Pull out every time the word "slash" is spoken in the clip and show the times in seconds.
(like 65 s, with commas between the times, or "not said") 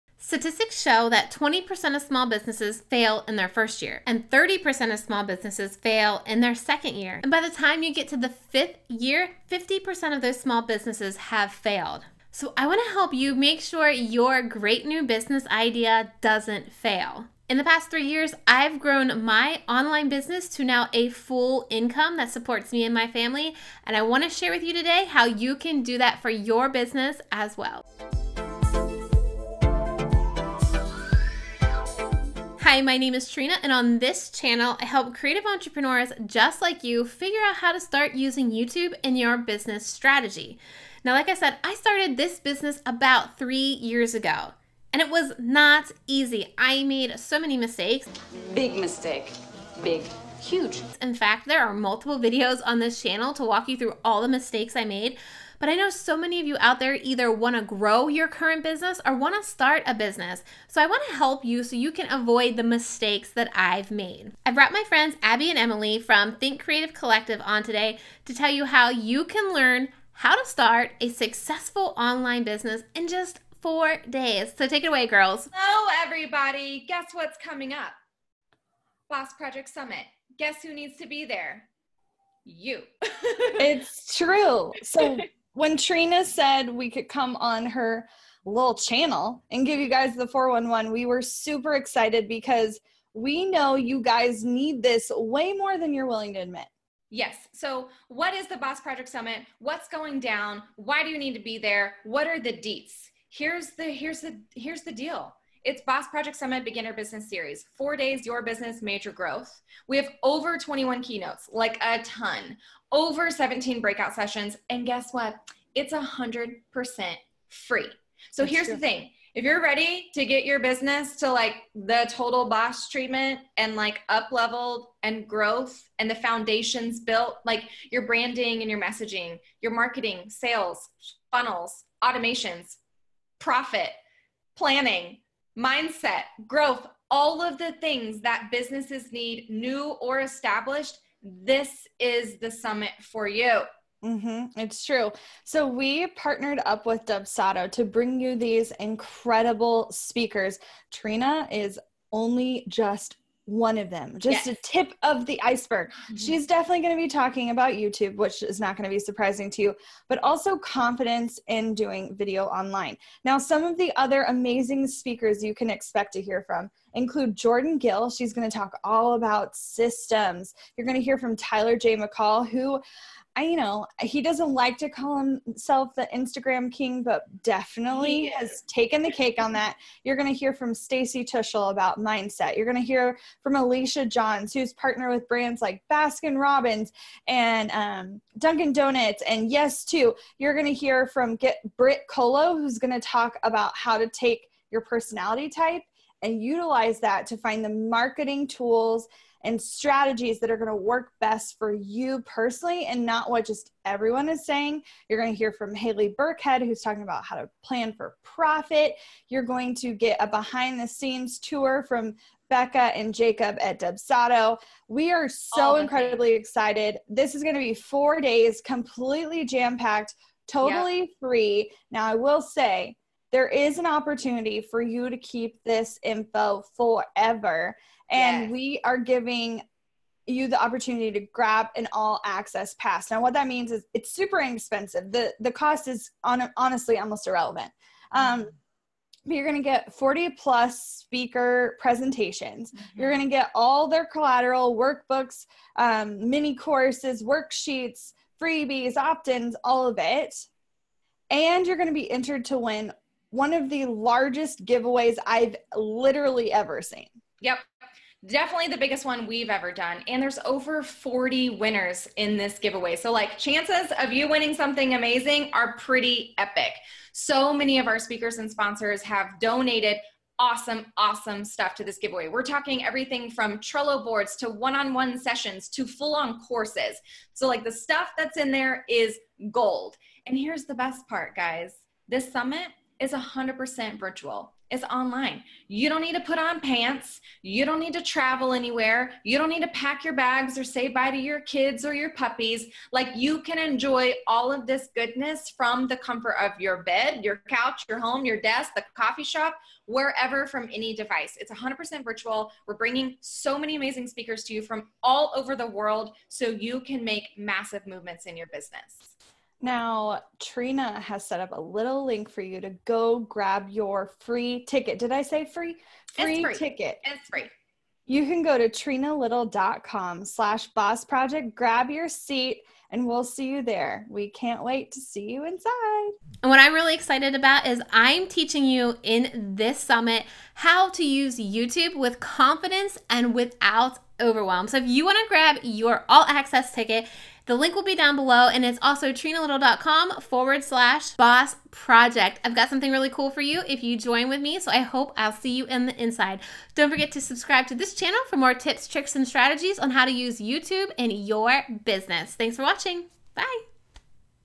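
320 s, 340 s.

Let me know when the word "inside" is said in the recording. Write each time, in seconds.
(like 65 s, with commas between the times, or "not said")
325 s, 346 s.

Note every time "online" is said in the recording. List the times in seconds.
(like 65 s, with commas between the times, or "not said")
19 s, 71 s, 162 s, 284 s.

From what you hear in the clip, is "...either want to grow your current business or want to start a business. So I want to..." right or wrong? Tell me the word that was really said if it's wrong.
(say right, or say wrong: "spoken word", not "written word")
right.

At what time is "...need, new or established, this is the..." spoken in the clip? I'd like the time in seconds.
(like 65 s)
139 s.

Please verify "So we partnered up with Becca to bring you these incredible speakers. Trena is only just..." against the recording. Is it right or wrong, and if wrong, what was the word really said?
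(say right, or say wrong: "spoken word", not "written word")
wrong: "Dubsado", not "Becca".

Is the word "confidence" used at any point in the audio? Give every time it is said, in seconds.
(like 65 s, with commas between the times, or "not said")
160 s, 332 s.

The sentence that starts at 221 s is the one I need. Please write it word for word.
Now, I will say, there is an opportunity for you to keep this info forever.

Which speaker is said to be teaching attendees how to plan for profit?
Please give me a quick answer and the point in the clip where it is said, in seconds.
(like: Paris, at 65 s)
Haley Burkhead, at 205 s.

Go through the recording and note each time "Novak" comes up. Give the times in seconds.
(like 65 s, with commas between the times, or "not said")
not said.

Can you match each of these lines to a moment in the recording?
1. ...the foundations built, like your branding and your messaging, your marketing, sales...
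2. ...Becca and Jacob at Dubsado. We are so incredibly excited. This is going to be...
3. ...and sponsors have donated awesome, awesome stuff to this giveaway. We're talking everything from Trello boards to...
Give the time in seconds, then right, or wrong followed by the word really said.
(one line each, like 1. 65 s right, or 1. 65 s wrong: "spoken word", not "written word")
1. 126 s right
2. 212 s right
3. 268 s right.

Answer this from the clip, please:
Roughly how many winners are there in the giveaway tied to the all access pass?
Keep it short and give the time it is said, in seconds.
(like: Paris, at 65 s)
over 40, at 260 s.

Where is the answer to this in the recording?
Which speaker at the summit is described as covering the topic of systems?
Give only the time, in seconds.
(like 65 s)
167 s.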